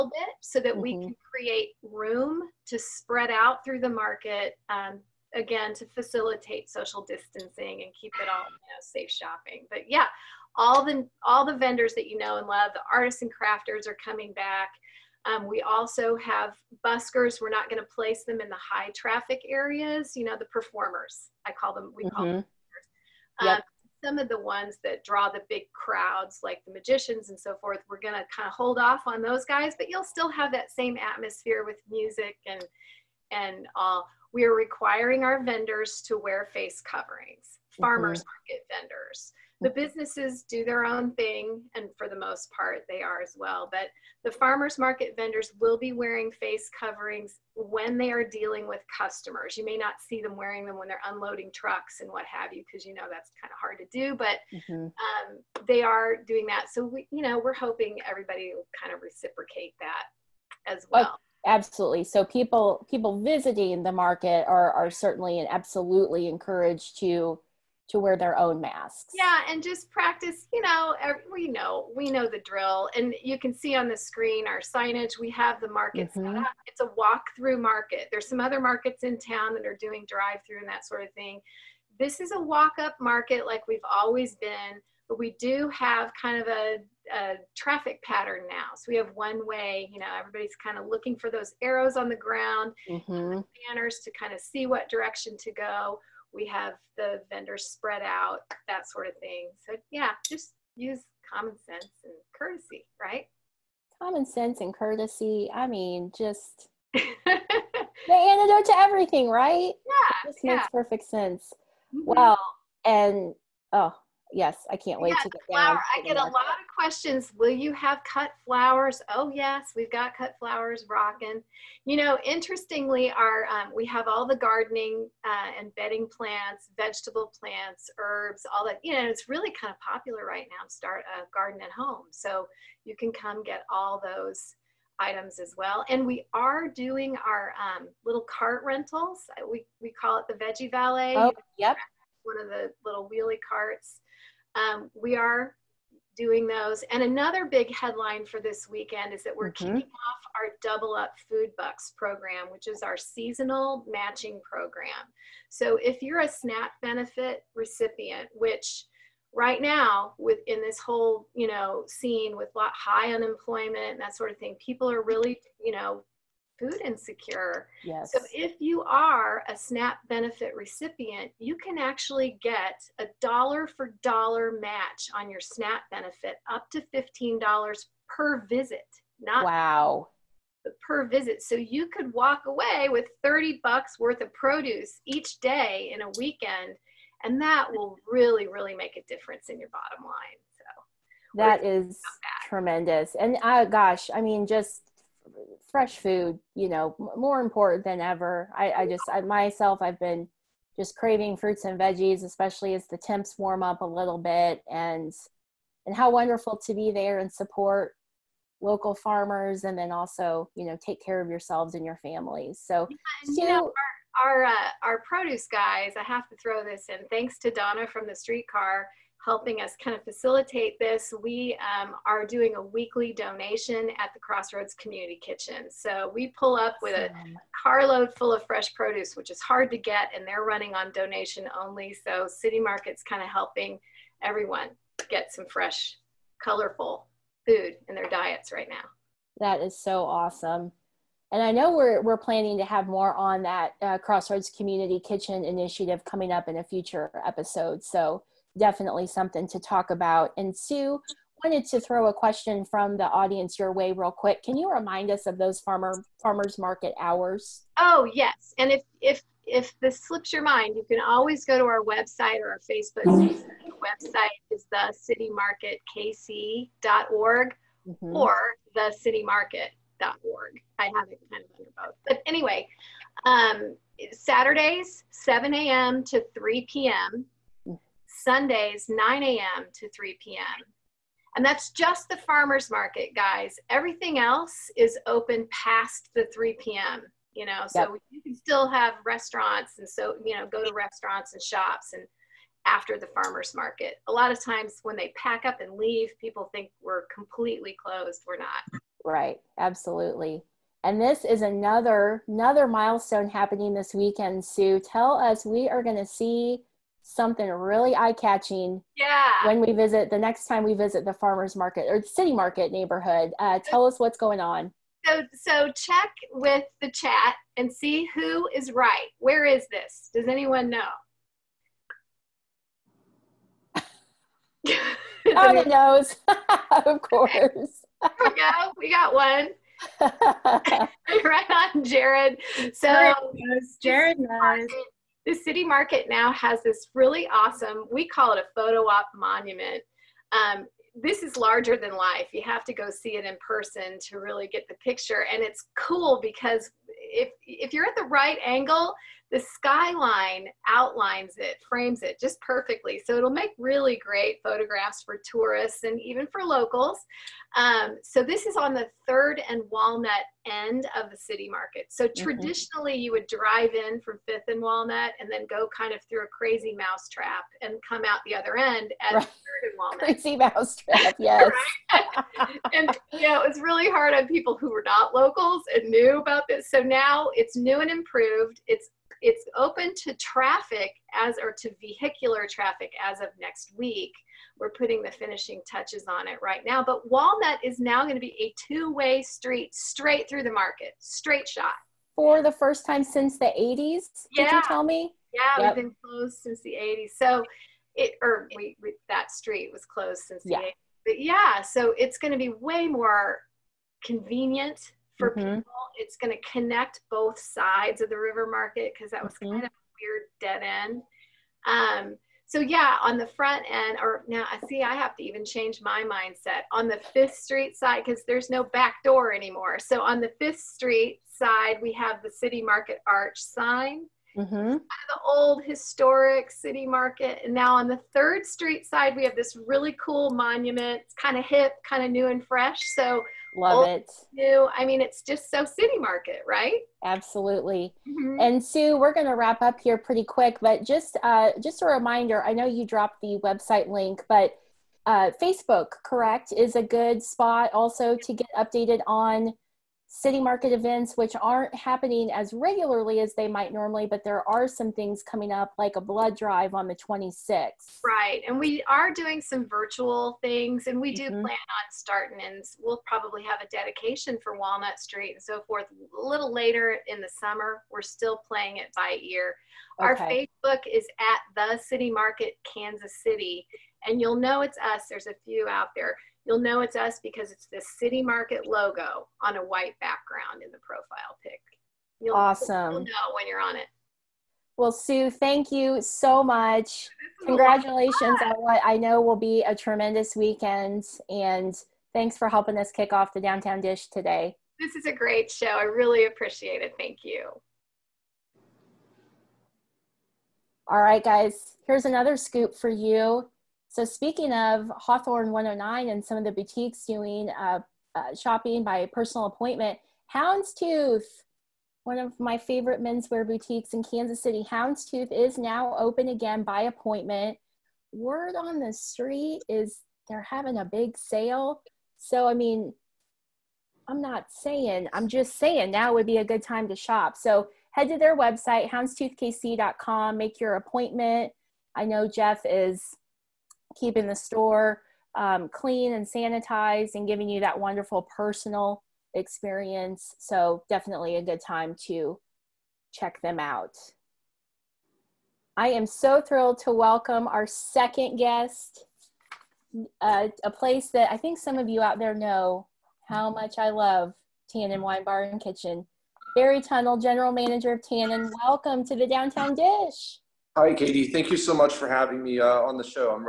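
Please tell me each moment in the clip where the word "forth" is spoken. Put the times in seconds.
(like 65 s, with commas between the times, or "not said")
27 s, 465 s.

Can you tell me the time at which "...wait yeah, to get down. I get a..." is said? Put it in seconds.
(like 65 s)
115 s.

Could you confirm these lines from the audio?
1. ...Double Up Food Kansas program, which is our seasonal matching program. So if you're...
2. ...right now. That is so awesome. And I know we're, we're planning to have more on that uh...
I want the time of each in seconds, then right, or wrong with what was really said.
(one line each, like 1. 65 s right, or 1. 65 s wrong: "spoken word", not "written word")
1. 150 s wrong: "Bucks", not "Kansas"
2. 238 s right.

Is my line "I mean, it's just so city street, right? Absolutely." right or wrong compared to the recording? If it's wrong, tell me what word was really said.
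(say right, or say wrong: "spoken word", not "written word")
wrong: "market", not "street".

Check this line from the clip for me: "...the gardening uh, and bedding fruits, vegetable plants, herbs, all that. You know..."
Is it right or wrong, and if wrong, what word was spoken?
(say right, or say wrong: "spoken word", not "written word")
wrong: "plants", not "fruits".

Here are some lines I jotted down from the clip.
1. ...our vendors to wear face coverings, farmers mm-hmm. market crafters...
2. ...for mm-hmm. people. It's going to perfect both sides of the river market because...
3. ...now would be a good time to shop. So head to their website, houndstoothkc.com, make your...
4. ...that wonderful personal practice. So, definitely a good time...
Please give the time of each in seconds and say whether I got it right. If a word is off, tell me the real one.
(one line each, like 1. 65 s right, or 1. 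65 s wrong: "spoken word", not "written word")
1. 35 s wrong: "vendors", not "crafters"
2. 405 s wrong: "connect", not "perfect"
3. 525 s right
4. 537 s wrong: "experience", not "practice".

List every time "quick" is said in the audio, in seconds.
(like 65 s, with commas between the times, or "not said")
254 s, 440 s.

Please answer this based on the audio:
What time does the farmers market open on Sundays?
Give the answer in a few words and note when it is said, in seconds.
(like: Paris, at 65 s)
9 a.m., at 278 s.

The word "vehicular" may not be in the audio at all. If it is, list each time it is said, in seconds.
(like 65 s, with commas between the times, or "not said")
381 s.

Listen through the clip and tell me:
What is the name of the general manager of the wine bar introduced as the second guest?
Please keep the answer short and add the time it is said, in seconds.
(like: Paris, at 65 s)
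Barry Tunnel, at 556 s.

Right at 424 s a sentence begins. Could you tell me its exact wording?
of the old historic city market.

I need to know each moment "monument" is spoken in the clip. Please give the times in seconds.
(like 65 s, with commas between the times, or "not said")
339 s, 430 s.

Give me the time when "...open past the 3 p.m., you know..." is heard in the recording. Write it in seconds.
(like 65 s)
285 s.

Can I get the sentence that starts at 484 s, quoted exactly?
Well, Sue, thank you so much.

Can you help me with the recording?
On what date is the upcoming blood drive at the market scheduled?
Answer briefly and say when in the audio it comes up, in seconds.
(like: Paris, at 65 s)
the 26th, at 456 s.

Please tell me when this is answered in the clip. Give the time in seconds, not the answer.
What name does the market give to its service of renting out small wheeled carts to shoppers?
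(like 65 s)
140 s.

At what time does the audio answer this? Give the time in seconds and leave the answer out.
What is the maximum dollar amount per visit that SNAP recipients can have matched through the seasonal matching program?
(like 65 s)
176 s.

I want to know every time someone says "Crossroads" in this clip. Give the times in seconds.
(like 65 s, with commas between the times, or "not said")
224 s, 243 s.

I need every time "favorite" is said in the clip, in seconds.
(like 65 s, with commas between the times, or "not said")
512 s.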